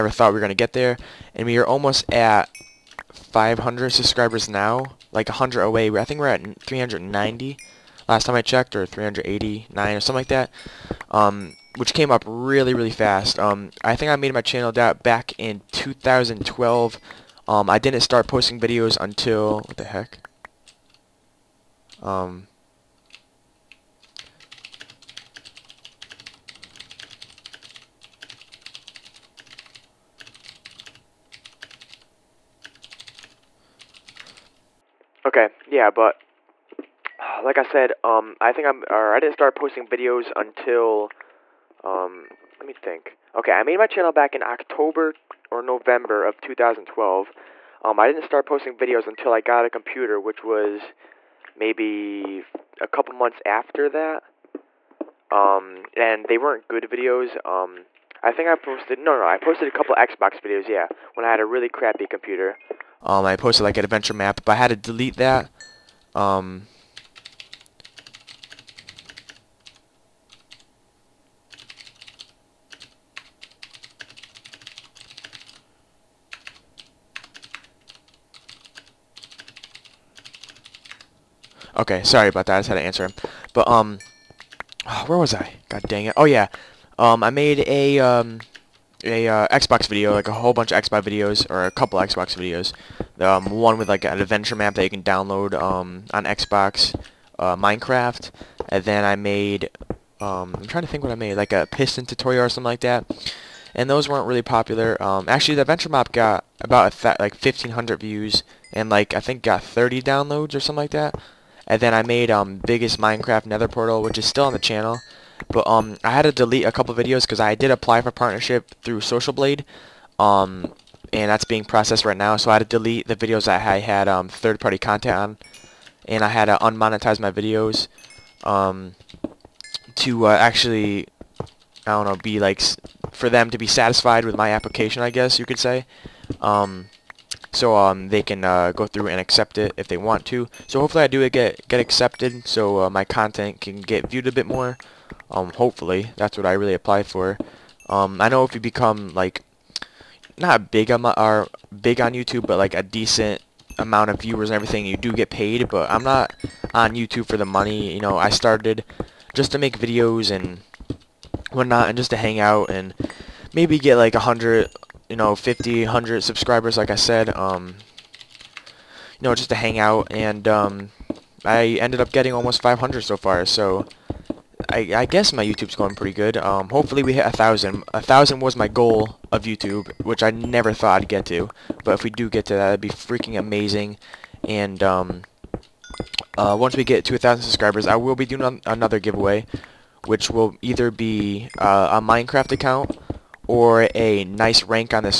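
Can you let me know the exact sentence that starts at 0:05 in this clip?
I think we're at 390 last time I checked, or 389 or something like that.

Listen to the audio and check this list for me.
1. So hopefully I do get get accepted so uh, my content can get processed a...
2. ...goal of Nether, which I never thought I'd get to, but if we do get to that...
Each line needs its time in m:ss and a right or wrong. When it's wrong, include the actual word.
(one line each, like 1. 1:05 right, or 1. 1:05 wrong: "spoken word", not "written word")
1. 2:20 wrong: "viewed", not "processed"
2. 2:58 wrong: "YouTube", not "Nether".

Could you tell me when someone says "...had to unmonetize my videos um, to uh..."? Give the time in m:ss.
2:06.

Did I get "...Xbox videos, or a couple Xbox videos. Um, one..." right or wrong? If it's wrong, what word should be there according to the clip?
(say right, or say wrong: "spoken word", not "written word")
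right.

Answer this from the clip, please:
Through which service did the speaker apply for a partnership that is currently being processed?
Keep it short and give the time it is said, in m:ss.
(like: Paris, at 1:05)
Social Blade, at 1:59.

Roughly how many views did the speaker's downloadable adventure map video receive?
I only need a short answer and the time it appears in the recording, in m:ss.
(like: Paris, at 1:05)
1,500, at 1:47.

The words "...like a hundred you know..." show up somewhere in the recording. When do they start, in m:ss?
2:43.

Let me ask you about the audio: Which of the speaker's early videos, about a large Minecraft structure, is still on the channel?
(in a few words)
Biggest Minecraft Nether portal.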